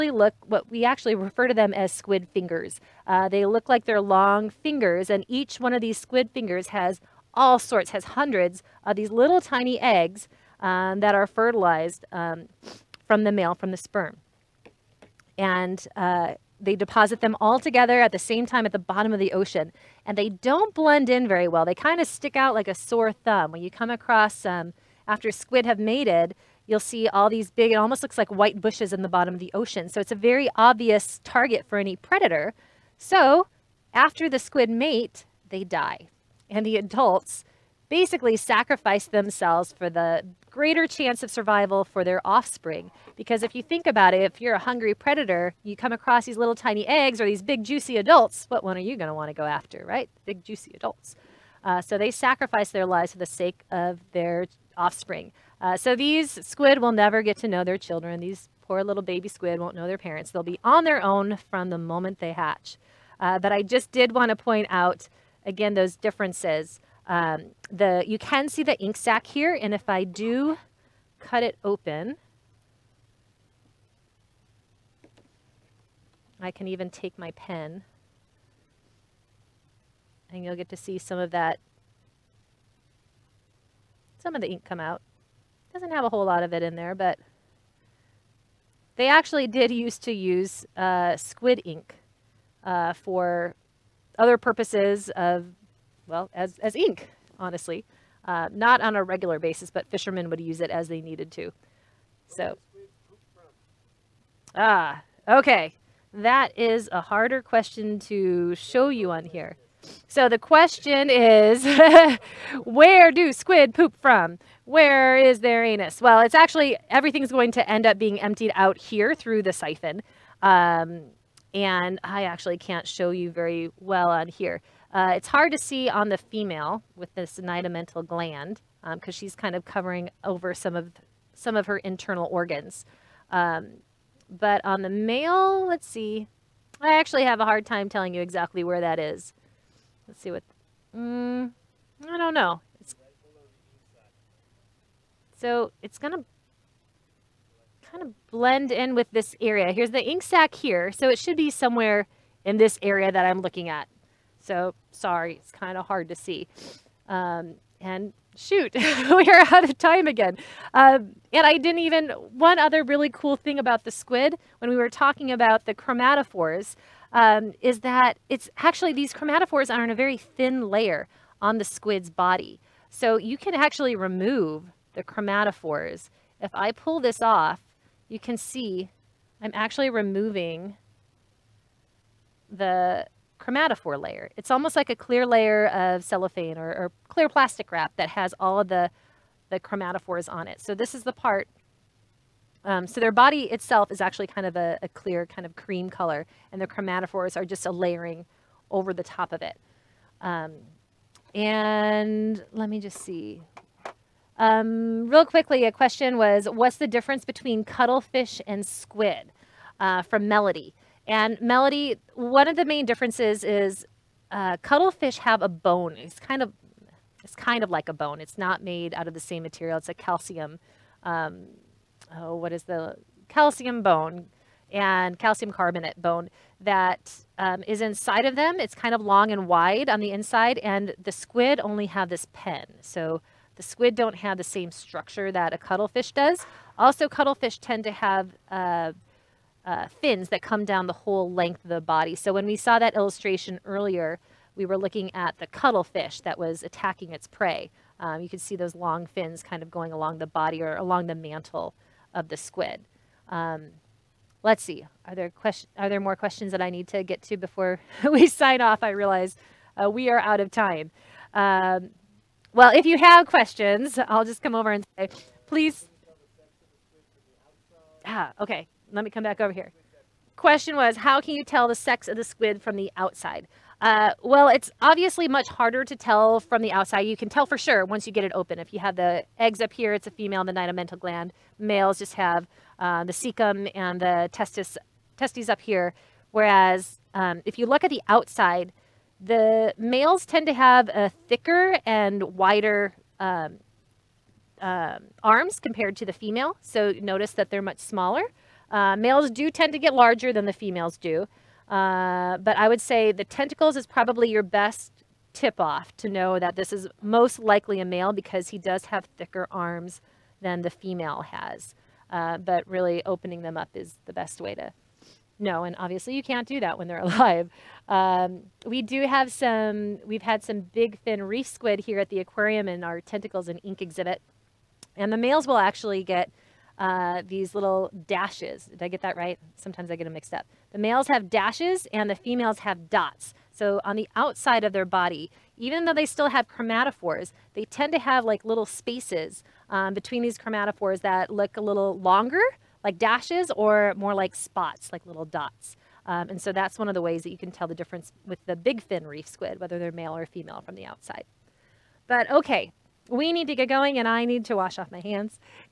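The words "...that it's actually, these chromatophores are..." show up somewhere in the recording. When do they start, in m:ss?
2:47.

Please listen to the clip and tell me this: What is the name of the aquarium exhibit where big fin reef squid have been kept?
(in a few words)
Tentacles and Ink.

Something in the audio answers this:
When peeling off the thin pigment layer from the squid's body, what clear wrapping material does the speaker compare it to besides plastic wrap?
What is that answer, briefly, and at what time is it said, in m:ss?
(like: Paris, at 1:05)
cellophane, at 3:06.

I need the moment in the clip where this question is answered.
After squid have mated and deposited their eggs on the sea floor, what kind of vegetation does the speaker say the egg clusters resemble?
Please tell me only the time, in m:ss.
0:28.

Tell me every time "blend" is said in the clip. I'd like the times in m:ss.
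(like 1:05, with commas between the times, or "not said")
0:20, 2:28.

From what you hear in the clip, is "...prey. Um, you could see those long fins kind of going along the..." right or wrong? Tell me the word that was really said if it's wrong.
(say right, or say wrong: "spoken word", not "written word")
right.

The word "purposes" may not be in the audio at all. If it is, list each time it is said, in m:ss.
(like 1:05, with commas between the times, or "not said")
1:34.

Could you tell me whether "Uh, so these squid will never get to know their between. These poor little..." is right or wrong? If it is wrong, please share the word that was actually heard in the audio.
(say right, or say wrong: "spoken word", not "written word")
wrong: "children", not "between".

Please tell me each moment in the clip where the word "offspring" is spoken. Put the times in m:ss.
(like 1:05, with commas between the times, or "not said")
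0:42, 0:54.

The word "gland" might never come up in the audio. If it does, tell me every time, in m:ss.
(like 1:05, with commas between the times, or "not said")
2:08, 4:40.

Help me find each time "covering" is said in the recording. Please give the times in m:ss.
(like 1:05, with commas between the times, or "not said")
2:09.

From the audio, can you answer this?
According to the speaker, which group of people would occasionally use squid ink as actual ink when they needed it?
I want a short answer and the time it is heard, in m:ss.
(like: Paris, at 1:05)
fishermen, at 1:39.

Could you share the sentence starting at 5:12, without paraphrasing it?
Uh, but really opening them up is the best way to know.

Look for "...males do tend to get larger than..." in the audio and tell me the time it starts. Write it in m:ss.
4:58.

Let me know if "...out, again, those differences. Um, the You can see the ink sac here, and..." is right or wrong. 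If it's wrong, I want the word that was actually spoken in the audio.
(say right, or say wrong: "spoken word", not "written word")
right.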